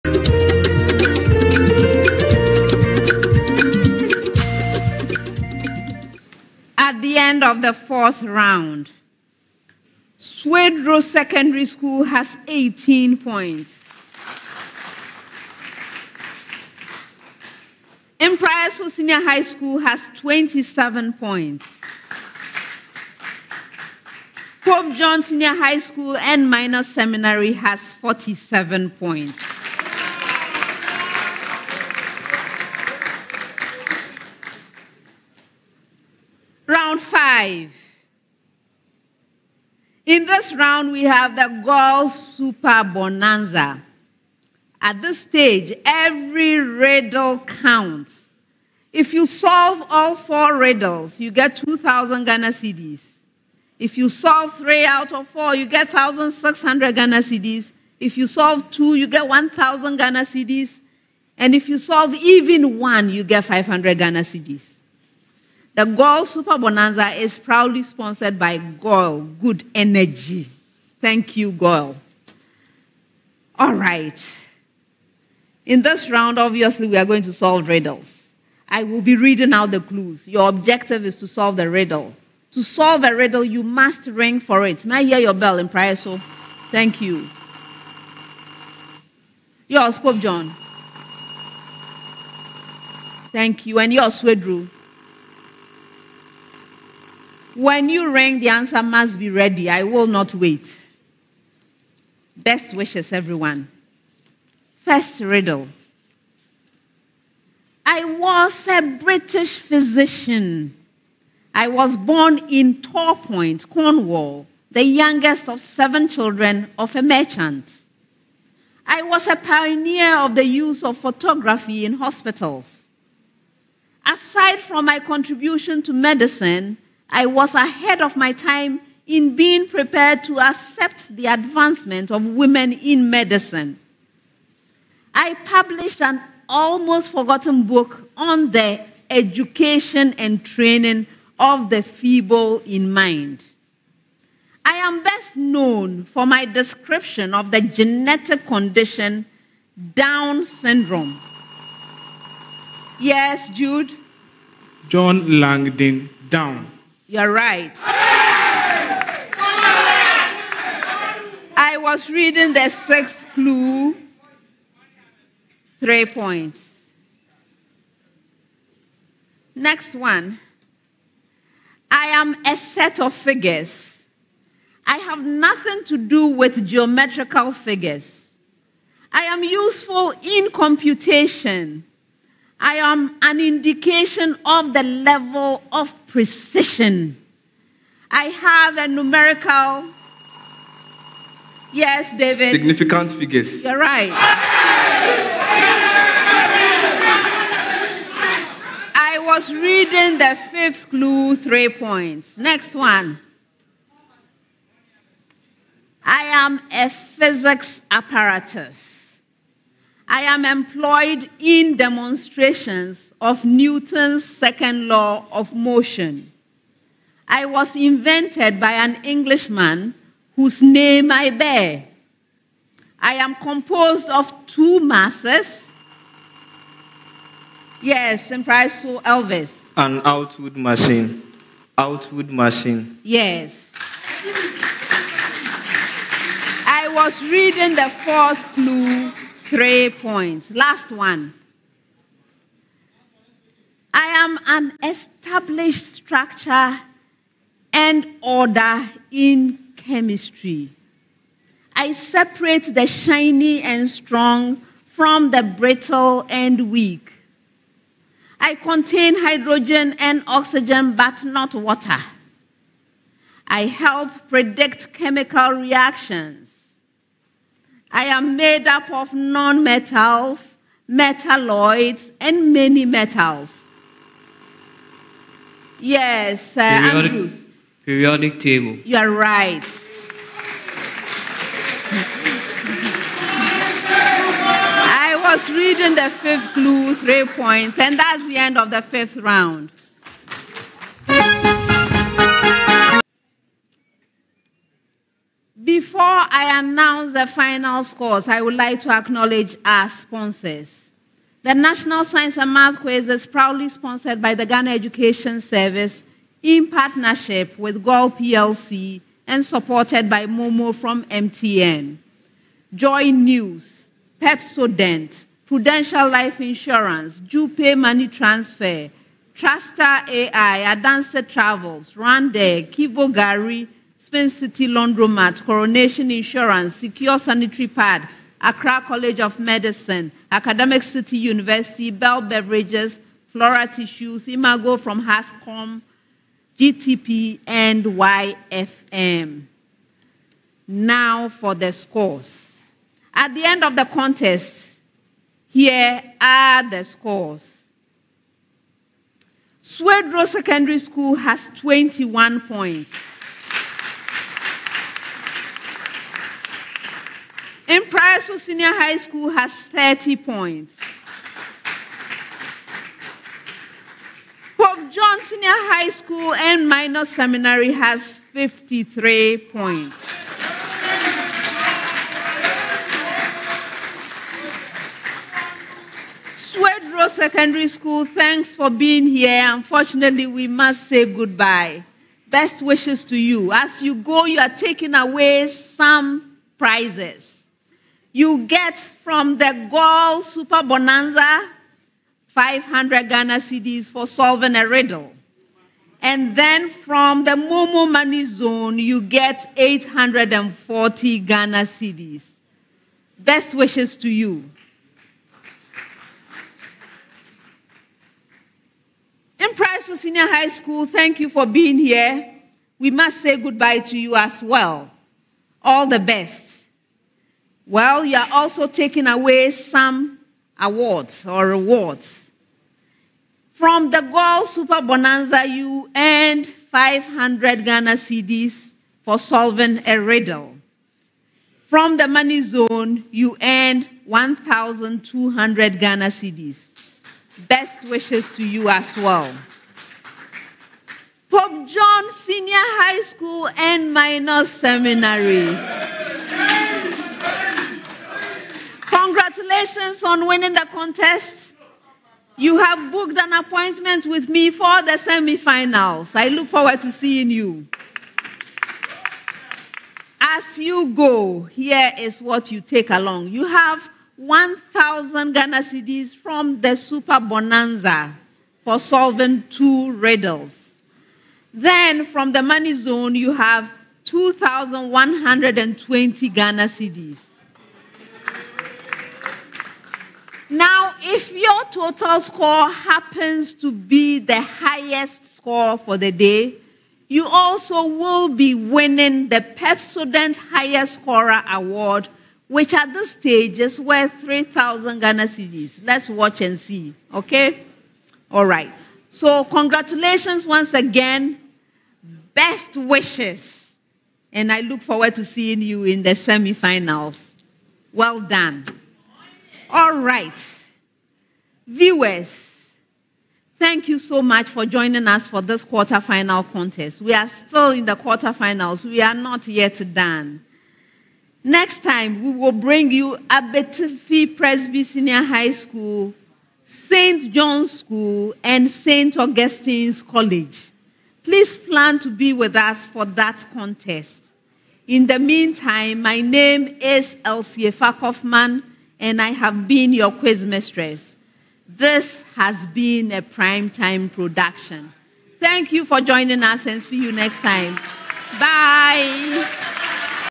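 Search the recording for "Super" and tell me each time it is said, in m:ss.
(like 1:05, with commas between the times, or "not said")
0:42, 1:06, 6:30, 7:04, 7:46.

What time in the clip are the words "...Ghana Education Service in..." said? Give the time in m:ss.
5:04.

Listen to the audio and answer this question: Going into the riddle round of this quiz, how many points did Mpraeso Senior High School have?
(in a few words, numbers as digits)
27.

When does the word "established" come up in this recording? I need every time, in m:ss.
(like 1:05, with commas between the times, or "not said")
4:04.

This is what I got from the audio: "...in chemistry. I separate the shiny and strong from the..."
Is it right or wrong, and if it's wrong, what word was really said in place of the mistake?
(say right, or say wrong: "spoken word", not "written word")
right.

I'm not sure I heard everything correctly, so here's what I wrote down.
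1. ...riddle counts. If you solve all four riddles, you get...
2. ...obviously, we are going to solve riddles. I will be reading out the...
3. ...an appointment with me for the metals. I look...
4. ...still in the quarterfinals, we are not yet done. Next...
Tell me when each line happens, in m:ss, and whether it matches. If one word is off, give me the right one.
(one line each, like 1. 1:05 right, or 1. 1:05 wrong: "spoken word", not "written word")
1. 0:46 right
2. 1:16 right
3. 7:33 wrong: "semifinals", not "metals"
4. 8:37 right.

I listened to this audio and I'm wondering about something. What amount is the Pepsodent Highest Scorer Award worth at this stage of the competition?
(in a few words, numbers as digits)
3,000 Ghana cedis.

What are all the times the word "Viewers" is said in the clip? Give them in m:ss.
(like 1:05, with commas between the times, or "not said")
8:31.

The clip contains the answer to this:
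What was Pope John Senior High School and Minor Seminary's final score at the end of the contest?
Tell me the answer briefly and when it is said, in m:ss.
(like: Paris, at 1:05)
53 points, at 6:08.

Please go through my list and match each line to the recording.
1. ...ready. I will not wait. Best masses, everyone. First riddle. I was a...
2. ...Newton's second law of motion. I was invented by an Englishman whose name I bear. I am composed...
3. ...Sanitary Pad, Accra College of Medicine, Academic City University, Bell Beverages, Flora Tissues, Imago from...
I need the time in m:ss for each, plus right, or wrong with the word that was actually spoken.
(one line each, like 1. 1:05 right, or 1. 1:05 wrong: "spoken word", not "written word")
1. 1:39 wrong: "wishes", not "masses"
2. 3:33 right
3. 5:27 right.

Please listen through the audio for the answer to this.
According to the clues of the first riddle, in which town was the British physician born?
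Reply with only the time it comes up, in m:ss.
1:52.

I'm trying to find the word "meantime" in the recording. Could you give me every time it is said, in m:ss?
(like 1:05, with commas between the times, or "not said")
8:55.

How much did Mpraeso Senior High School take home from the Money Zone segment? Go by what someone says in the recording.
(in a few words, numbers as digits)
1,200 Ghana cedis.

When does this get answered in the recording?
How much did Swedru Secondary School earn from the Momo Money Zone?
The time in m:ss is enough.
6:39.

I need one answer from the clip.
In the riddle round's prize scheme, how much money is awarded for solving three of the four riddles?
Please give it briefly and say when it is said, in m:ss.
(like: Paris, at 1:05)
1,600 Ghana cedis, at 0:55.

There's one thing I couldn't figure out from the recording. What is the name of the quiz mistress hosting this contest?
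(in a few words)
Elsie Kaufmann.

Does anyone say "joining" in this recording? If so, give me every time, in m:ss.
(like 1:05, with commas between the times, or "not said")
8:34, 9:06.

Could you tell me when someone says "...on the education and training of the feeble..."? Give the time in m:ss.
2:18.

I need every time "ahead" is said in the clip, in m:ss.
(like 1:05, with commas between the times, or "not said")
2:07.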